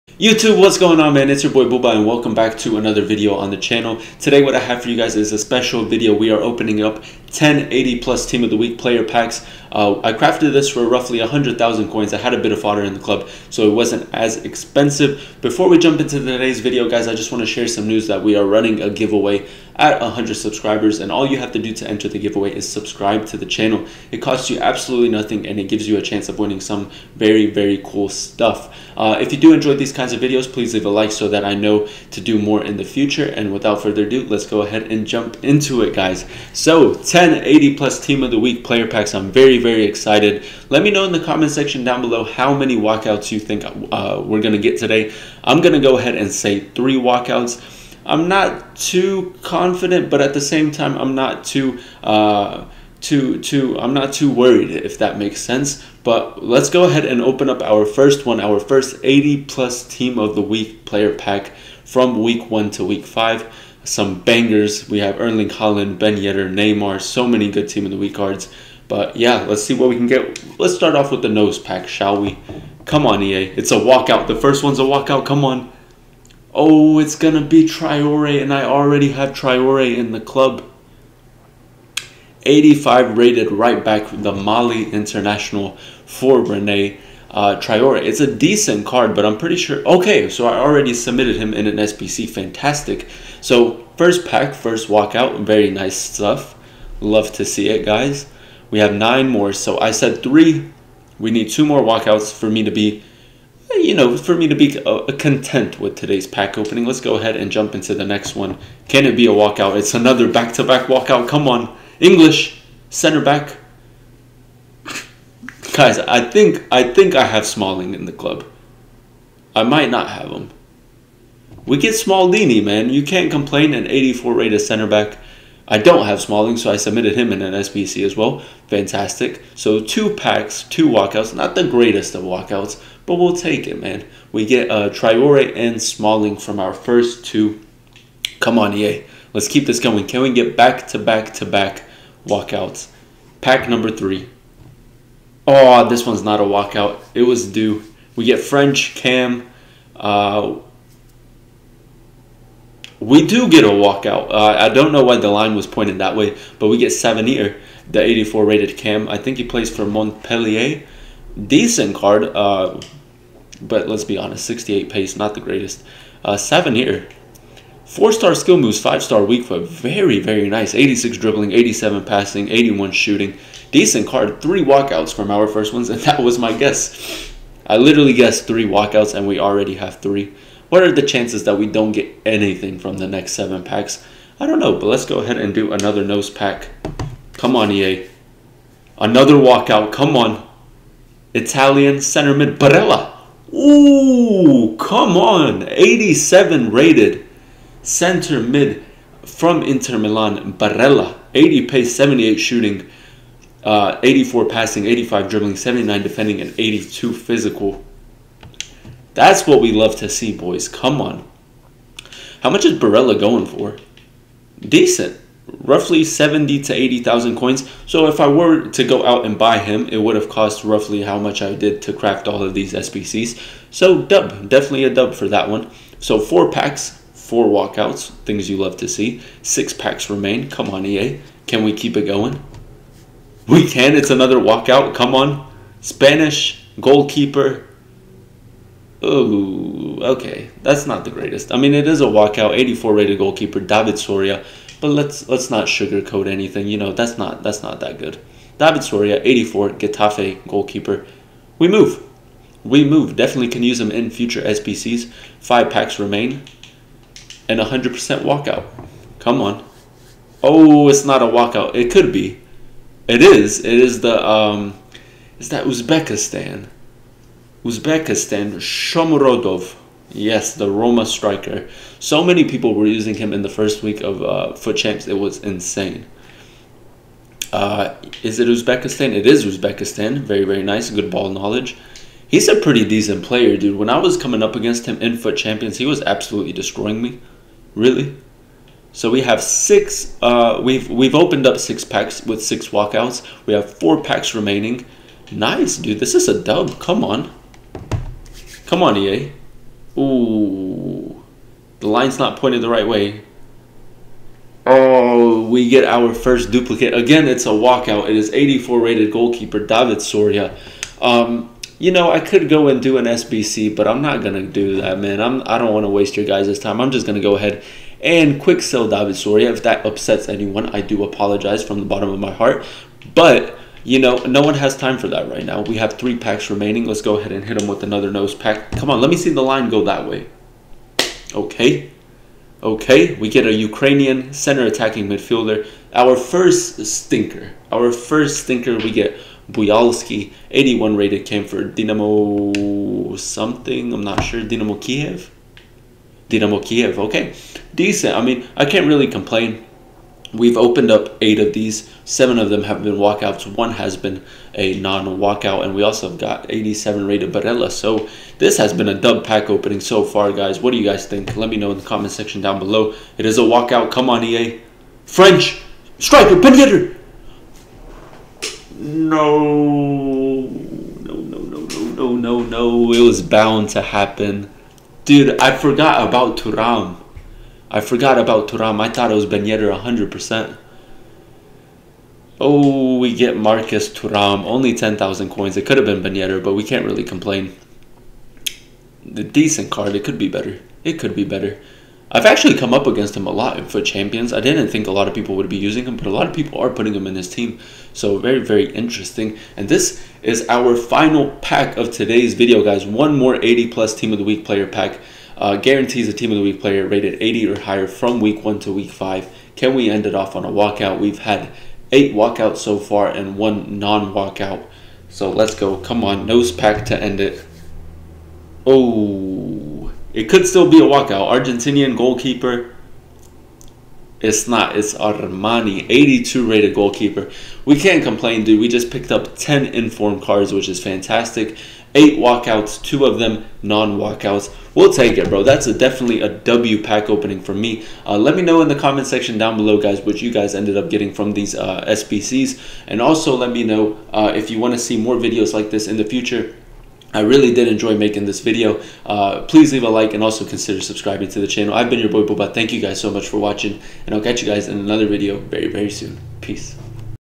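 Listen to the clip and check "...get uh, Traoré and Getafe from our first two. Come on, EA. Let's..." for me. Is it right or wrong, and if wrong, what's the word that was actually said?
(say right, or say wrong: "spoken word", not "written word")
wrong: "Smalling", not "Getafe".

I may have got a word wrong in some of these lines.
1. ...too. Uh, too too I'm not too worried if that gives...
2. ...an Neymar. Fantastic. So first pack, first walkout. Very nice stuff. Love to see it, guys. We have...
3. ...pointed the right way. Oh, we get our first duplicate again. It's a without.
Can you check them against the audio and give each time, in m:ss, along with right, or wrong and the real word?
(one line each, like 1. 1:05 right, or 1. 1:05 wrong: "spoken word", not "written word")
1. 0:51 wrong: "makes", not "gives"
2. 1:31 wrong: "SBC", not "Neymar"
3. 5:02 wrong: "walkout", not "without".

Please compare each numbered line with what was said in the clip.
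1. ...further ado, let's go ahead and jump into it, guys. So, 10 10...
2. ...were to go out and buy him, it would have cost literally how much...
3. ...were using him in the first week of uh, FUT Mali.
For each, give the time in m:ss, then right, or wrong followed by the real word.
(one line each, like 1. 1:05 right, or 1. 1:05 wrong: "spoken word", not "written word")
1. 0:33 right
2. 3:38 wrong: "roughly", not "literally"
3. 4:32 wrong: "Champs", not "Mali".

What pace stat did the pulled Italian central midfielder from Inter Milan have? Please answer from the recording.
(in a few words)
80.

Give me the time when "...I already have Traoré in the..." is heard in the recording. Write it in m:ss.
1:18.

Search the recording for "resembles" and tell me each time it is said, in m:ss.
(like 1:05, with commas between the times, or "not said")
not said.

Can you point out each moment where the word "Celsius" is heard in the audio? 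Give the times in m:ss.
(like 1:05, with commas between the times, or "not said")
not said.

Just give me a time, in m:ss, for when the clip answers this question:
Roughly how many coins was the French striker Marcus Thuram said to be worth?
6:24.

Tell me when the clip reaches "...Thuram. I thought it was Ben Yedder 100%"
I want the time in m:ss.
6:18.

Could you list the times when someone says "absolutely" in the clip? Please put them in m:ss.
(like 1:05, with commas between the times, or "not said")
0:24, 4:46.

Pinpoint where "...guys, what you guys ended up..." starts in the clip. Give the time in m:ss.
7:19.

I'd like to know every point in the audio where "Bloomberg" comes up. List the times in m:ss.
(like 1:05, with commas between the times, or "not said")
not said.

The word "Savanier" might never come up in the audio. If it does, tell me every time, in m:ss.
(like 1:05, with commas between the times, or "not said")
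2:36, 2:46.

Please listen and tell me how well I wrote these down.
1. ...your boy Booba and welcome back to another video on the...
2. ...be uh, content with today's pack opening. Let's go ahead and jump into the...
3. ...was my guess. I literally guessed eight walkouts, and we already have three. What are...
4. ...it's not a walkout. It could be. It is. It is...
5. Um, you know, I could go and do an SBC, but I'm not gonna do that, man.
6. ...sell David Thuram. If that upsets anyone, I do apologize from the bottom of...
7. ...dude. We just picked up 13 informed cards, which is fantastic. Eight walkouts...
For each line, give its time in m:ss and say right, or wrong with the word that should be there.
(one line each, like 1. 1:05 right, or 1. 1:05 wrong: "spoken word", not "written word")
1. 0:01 right
2. 1:44 right
3. 2:56 wrong: "three", not "eight"
4. 4:20 right
5. 5:11 right
6. 5:18 wrong: "Soria", not "Thuram"
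7. 7:08 wrong: "10", not "13".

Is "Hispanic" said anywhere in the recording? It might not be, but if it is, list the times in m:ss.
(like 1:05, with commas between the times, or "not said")
not said.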